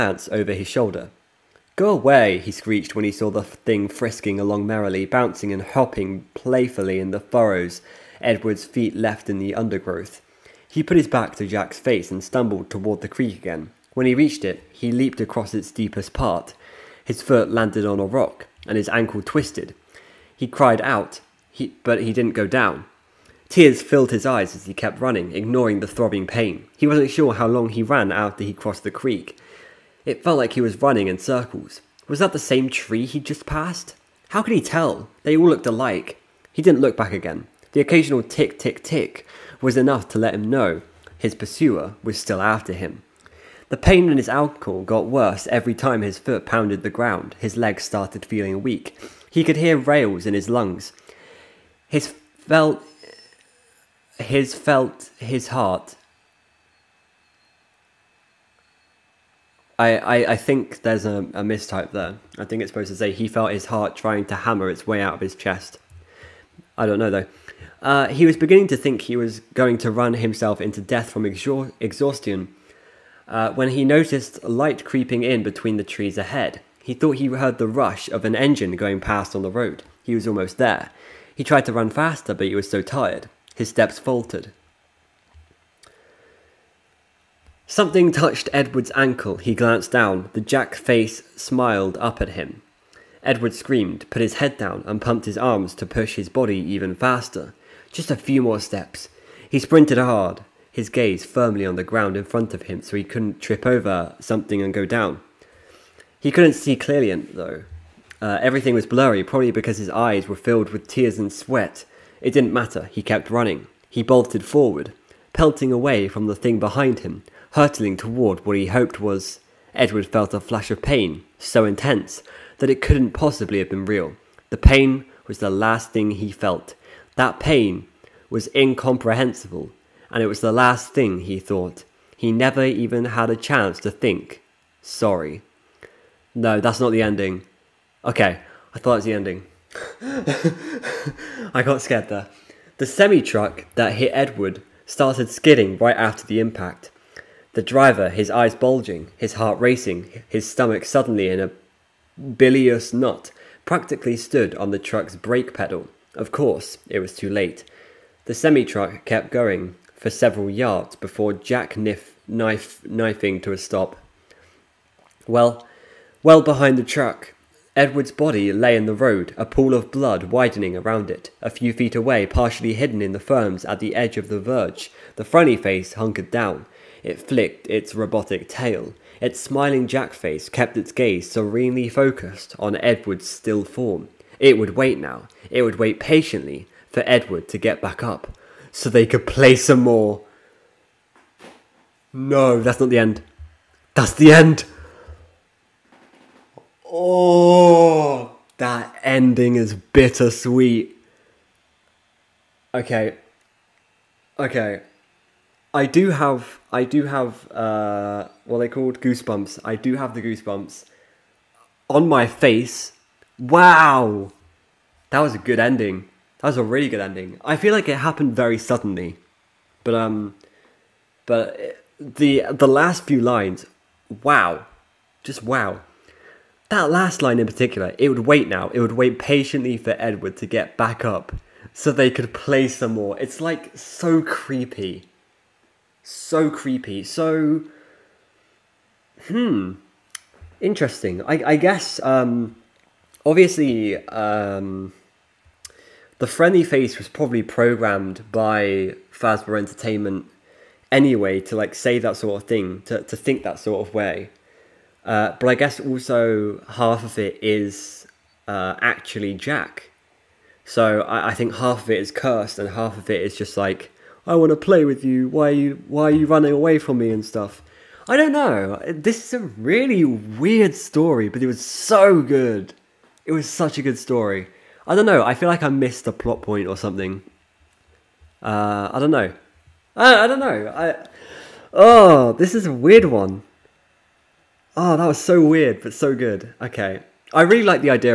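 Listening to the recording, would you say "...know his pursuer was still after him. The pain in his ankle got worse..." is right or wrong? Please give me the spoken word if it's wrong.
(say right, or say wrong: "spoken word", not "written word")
right.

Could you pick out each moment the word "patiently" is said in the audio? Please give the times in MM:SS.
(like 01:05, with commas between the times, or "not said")
03:05, 03:49.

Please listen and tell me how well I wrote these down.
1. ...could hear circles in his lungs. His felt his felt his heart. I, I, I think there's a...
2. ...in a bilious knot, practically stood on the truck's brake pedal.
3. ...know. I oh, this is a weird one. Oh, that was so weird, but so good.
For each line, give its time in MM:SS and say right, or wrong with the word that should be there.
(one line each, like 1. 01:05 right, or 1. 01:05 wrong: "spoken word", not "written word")
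1. 00:49 wrong: "rales", not "circles"
2. 02:31 right
3. 04:40 right.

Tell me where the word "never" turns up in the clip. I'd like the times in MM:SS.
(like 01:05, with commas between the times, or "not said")
02:12.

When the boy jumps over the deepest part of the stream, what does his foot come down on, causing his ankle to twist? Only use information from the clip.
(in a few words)
a rock.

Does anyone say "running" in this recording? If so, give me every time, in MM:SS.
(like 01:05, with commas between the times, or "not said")
00:24, 00:30, 01:53, 04:26.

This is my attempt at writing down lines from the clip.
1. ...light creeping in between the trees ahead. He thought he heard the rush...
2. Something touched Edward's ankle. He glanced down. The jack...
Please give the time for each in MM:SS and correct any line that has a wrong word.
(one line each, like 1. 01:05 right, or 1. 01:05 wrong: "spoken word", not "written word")
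1. 01:14 right
2. 01:27 right.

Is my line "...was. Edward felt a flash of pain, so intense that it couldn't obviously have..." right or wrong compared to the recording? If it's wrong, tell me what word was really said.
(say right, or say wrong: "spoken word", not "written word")
wrong: "possibly", not "obviously".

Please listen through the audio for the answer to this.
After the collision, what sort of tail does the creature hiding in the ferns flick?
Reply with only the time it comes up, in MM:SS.
02:57.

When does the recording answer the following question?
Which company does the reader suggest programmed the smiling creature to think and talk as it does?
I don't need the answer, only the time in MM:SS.
04:09.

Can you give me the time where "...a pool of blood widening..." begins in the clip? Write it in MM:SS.
02:49.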